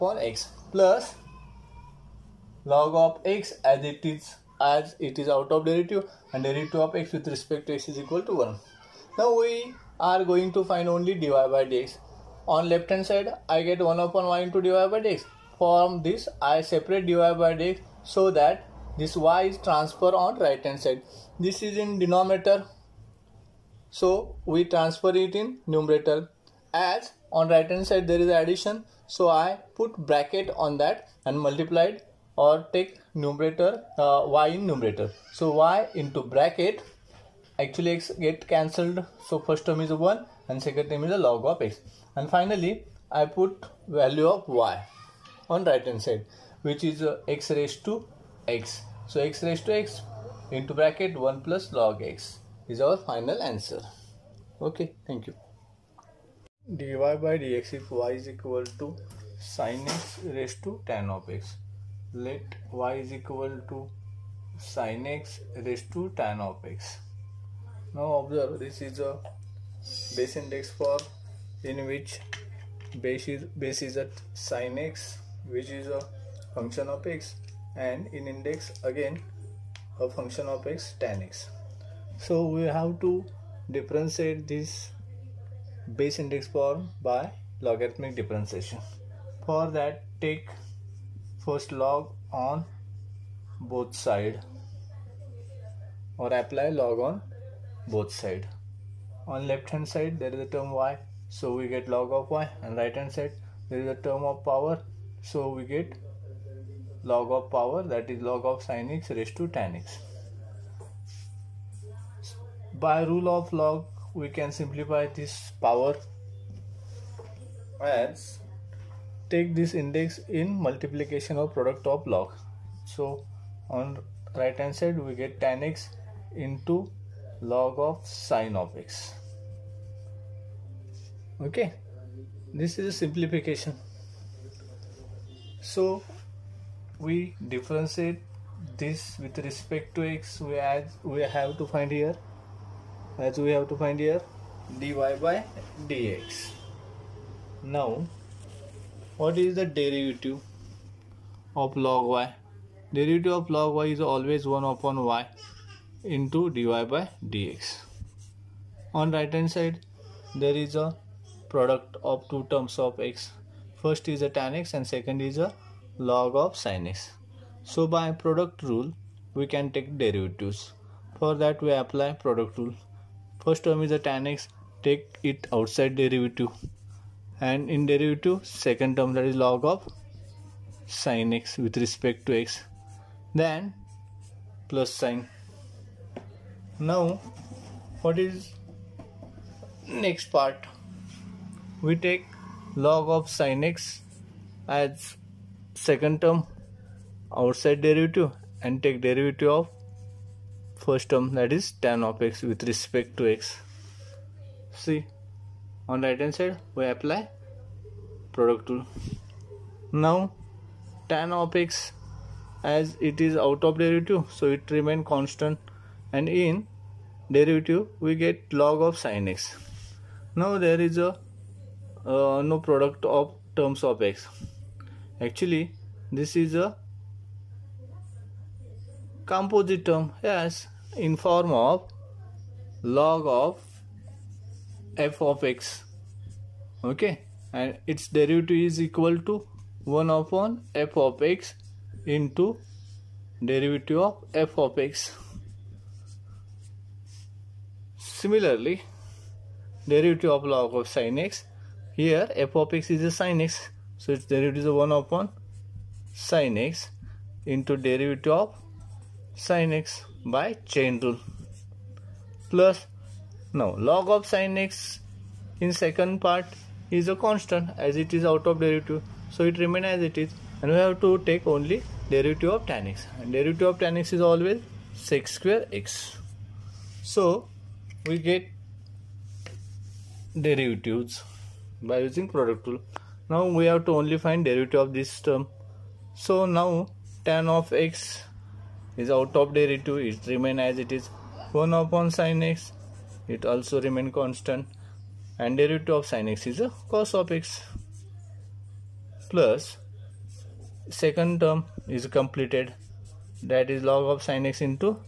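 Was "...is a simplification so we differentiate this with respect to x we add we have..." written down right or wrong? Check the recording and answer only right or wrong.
right.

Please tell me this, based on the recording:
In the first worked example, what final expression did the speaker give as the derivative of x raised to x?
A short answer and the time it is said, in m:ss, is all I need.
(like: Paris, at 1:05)
x^x(1 + log x), at 0:49.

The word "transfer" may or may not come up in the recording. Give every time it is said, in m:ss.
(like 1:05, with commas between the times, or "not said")
0:19, 0:24.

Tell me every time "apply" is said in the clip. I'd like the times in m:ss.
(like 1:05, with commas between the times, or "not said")
1:36, 2:51, 3:26.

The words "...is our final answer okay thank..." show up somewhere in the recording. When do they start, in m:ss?
0:52.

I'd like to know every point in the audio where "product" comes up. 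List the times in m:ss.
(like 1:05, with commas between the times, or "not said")
2:01, 2:41, 2:48, 2:52, 3:28, 3:42, 4:42.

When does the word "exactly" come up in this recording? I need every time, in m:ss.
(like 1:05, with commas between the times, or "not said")
not said.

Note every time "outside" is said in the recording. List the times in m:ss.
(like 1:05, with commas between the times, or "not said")
2:55, 3:17.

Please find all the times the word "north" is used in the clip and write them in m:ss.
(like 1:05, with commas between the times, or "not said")
not said.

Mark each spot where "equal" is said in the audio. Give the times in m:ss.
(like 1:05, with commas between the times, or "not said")
0:07, 0:58, 1:03, 3:58.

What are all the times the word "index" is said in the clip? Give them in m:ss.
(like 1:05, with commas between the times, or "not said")
1:10, 1:18, 1:26, 1:59.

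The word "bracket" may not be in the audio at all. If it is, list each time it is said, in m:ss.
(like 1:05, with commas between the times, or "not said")
0:30, 0:36, 0:50.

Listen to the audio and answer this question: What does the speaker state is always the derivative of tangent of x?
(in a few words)
sec² x.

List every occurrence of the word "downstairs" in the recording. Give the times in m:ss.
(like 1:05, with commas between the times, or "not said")
not said.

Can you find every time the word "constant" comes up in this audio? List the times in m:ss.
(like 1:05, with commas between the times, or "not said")
3:35, 4:27, 4:54.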